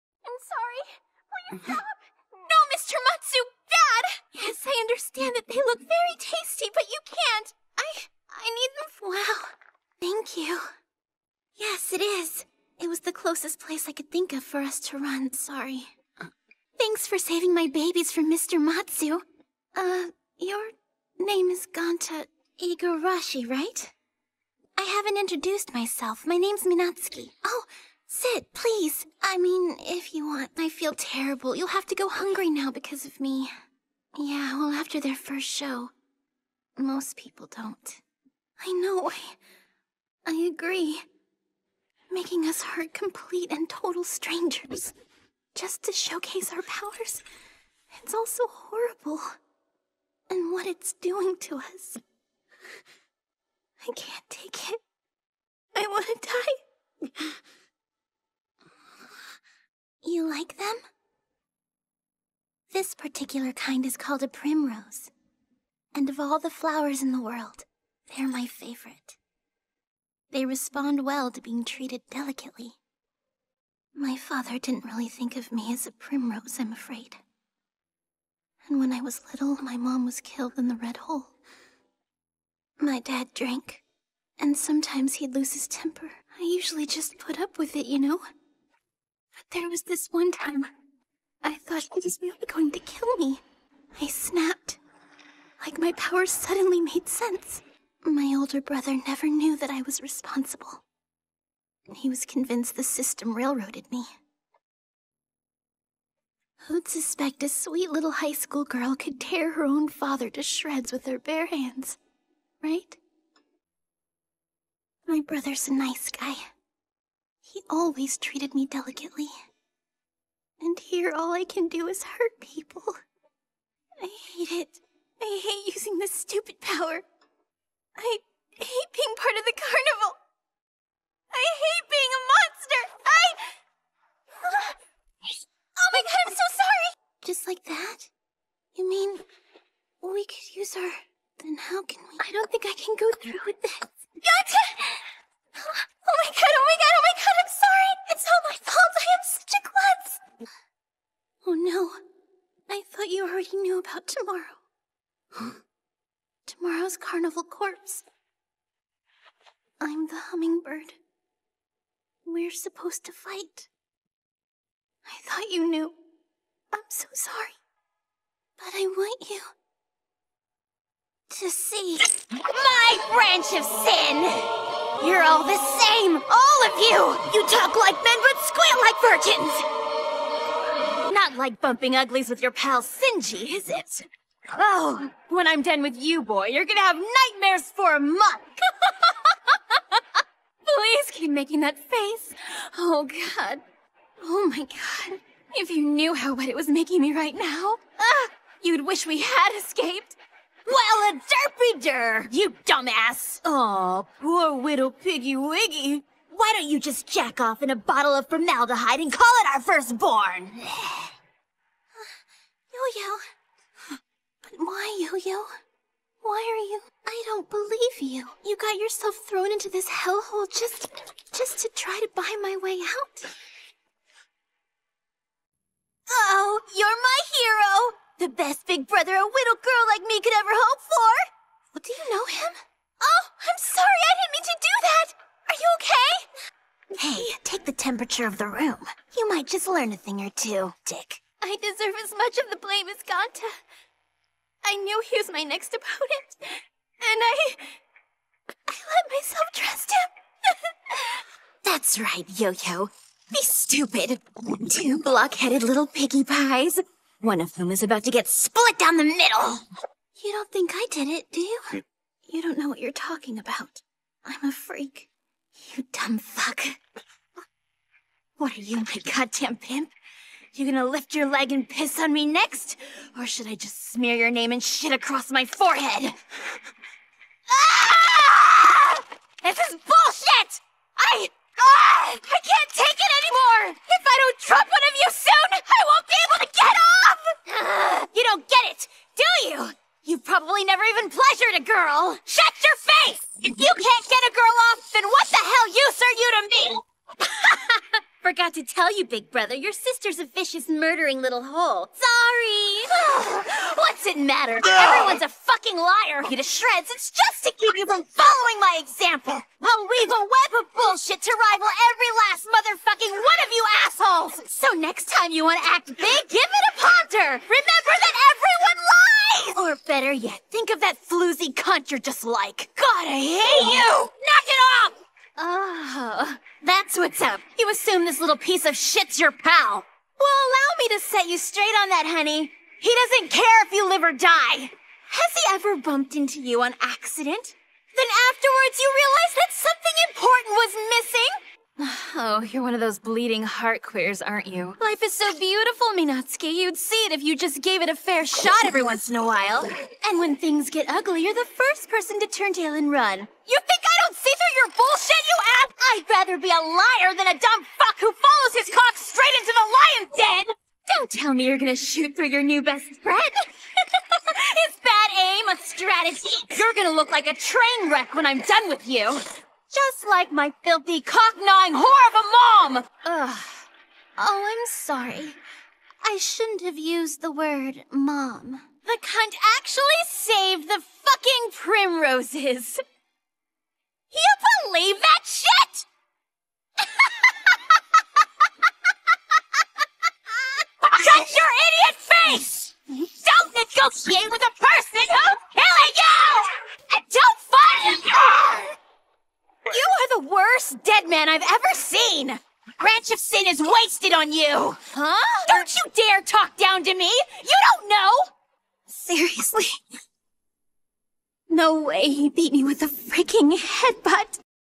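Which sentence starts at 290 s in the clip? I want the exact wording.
You've probably never even pleasured a girl!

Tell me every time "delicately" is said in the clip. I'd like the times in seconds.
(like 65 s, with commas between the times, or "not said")
72 s, 118 s.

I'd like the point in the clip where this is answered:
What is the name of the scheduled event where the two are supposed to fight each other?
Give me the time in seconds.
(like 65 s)
156 s.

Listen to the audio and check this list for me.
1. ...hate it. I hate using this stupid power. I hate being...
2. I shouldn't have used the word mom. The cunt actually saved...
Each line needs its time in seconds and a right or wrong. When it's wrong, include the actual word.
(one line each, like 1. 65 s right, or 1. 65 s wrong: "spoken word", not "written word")
1. 124 s right
2. 376 s right.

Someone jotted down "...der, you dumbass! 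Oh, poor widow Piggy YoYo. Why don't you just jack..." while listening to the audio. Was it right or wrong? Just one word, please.
wrong.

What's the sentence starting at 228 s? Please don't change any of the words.
The best big brother a little girl like me could ever hope for!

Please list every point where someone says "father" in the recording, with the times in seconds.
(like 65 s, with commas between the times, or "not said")
74 s, 109 s.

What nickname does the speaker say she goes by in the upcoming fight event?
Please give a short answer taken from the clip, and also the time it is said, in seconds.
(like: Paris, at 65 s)
the hummingbird, at 160 s.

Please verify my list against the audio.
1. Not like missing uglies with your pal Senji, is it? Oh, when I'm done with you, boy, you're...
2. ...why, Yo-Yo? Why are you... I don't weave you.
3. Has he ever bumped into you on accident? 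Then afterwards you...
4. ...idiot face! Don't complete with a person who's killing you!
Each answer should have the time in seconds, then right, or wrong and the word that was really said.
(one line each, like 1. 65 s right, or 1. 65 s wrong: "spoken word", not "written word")
1. 181 s wrong: "bumping", not "missing"
2. 214 s wrong: "believe", not "weave"
3. 334 s right
4. 391 s wrong: "negotiate", not "complete".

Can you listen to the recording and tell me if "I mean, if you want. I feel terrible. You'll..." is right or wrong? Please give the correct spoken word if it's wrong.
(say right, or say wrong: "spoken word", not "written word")
right.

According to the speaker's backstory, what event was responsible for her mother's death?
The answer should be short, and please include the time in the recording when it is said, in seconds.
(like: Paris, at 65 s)
the Red Hole, at 80 s.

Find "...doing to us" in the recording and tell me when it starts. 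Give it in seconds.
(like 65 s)
50 s.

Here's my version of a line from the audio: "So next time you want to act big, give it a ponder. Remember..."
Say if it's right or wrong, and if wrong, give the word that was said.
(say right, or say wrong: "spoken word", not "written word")
right.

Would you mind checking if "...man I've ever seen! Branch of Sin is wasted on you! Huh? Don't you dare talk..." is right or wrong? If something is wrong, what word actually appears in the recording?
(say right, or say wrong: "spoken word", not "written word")
right.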